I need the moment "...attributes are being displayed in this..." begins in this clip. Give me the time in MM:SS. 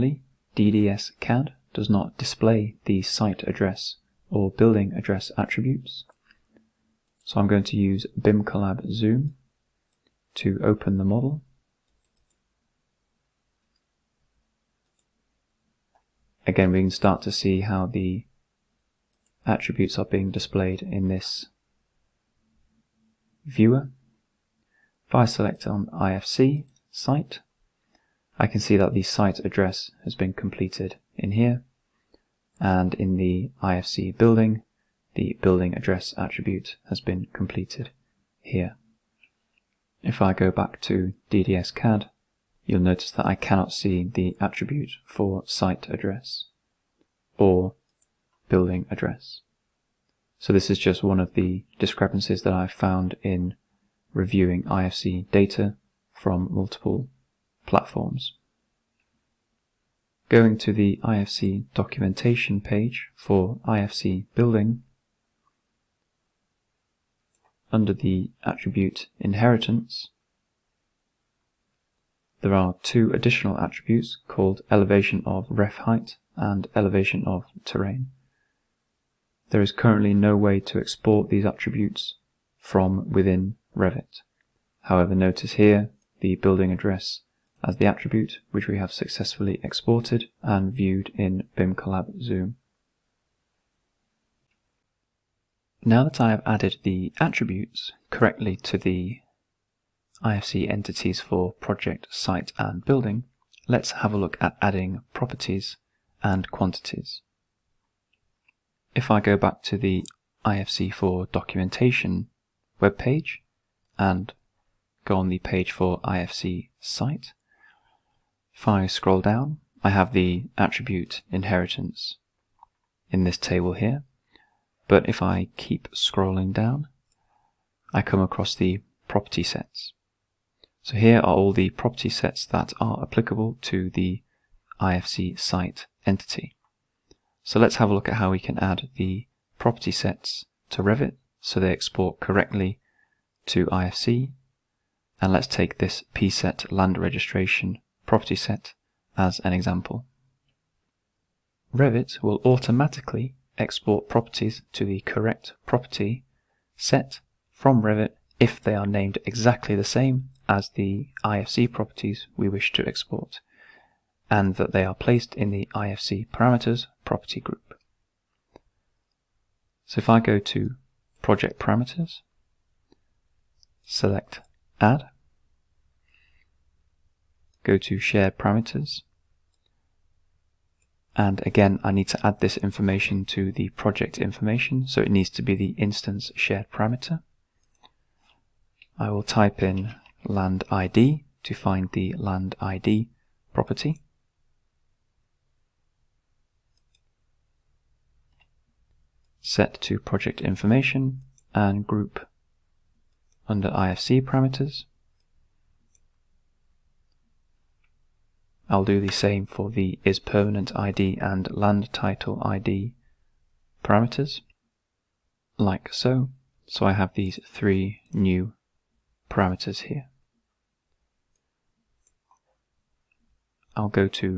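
00:19.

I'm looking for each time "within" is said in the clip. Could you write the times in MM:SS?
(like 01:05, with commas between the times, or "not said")
01:23.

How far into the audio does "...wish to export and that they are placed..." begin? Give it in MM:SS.
02:42.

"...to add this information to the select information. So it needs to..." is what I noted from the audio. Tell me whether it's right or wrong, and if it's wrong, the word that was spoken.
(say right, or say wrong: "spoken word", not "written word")
wrong: "project", not "select".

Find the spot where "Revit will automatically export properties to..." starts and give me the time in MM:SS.
02:31.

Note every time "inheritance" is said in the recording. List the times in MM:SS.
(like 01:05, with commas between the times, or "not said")
01:09, 02:01.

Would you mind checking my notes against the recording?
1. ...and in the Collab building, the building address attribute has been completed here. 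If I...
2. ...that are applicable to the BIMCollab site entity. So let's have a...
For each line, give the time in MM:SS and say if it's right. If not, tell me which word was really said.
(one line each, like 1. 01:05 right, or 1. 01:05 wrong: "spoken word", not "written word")
1. 00:32 wrong: "IFC", not "Collab"
2. 02:12 wrong: "IFC", not "BIMCollab".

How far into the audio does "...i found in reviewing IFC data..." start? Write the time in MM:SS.
00:52.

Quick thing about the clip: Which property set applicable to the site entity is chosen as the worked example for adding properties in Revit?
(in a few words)
Pset land registration.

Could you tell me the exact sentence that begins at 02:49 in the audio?
So if I go to project parameters, select add, go to share parameters.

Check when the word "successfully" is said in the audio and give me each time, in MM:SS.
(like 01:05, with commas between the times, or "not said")
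01:28.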